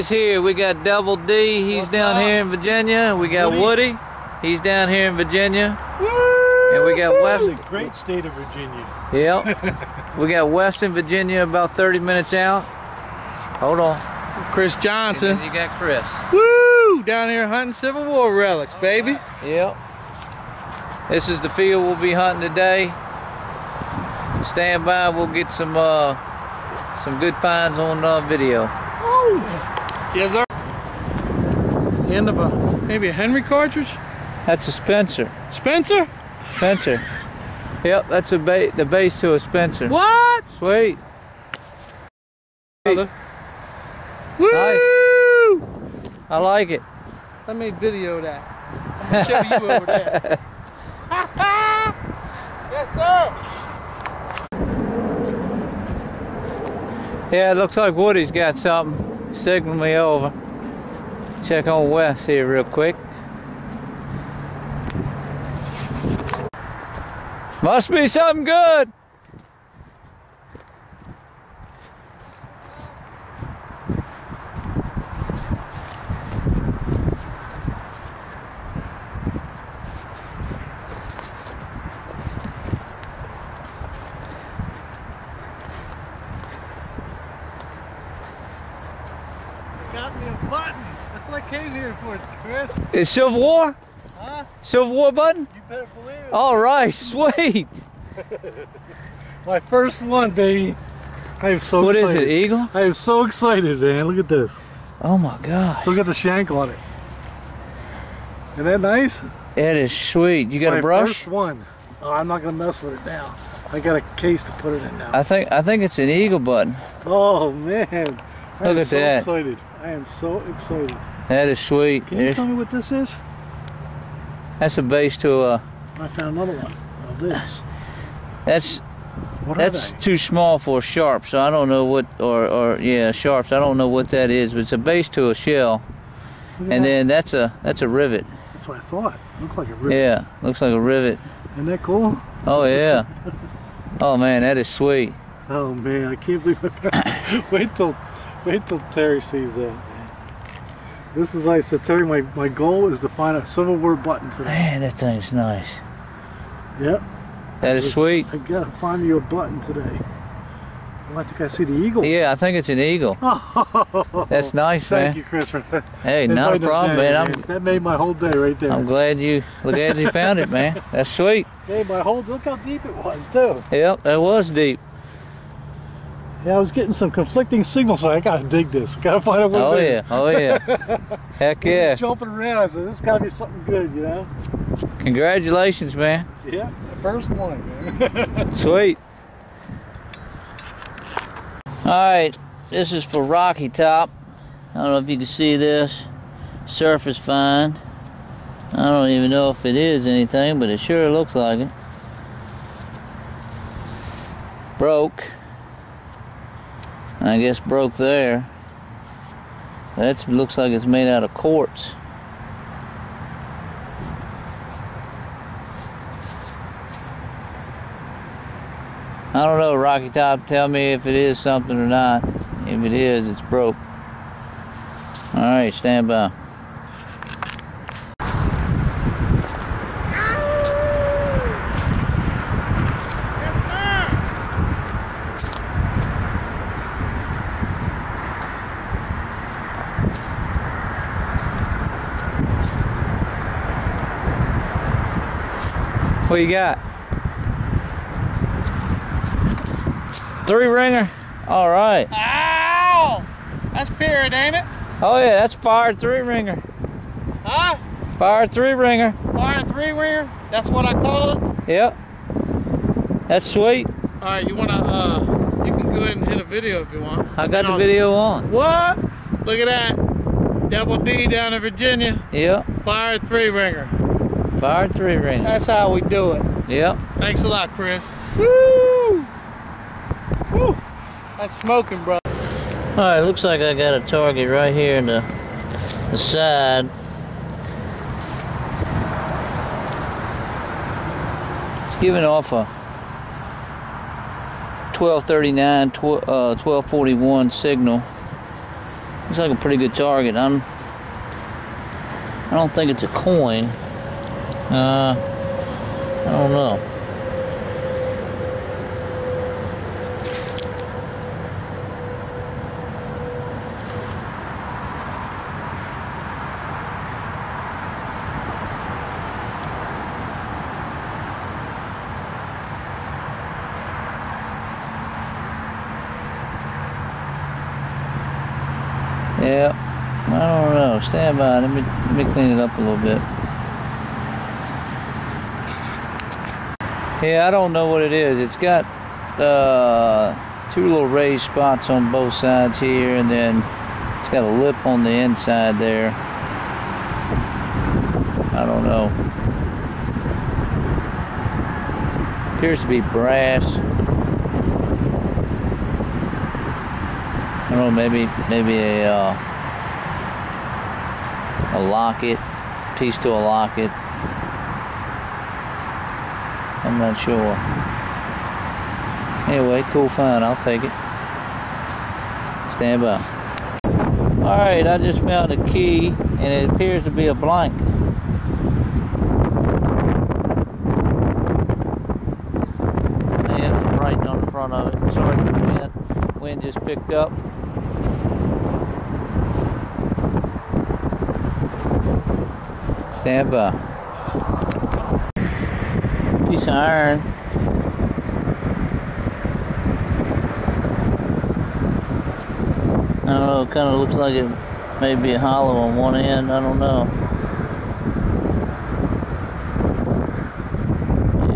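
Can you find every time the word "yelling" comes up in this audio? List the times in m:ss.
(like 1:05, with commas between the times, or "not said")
not said.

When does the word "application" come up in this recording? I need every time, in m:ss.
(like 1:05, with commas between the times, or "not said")
not said.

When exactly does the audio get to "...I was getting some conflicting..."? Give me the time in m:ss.
2:56.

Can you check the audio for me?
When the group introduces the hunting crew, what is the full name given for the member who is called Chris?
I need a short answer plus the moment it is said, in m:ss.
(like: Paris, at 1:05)
Chris Johnson, at 0:14.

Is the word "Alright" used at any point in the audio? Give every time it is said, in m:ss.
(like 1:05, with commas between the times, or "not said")
3:45, 6:14.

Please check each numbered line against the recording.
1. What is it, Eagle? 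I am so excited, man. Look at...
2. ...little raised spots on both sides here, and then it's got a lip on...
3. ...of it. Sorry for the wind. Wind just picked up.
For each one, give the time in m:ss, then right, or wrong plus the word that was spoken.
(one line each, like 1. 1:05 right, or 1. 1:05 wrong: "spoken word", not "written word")
1. 1:42 right
2. 5:40 right
3. 6:24 right.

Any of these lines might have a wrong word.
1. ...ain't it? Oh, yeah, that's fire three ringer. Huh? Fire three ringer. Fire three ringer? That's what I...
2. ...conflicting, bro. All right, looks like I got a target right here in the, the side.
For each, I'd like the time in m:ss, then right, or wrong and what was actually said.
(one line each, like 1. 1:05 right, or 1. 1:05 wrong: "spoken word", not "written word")
1. 4:14 right
2. 4:41 wrong: "smoking", not "conflicting".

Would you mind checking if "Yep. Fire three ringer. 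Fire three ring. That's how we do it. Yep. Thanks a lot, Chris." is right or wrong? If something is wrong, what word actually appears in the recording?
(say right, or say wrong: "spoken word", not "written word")
right.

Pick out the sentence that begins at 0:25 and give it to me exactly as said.
We'll get some uh, some good finds on uh, video.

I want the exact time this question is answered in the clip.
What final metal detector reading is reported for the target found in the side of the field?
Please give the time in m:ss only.
4:56.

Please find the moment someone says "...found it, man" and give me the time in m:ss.
2:50.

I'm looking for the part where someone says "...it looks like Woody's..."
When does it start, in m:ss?
0:57.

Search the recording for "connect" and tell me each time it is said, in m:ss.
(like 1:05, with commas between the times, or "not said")
not said.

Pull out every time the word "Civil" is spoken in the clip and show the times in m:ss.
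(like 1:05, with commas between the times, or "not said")
0:17, 2:33.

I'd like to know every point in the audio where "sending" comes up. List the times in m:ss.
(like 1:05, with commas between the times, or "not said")
not said.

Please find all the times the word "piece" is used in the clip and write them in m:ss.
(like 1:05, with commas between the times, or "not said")
6:02, 6:36.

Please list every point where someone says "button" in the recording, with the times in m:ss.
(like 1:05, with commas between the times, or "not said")
1:35, 1:56, 2:33, 2:39.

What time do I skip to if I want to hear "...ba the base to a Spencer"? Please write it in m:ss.
0:38.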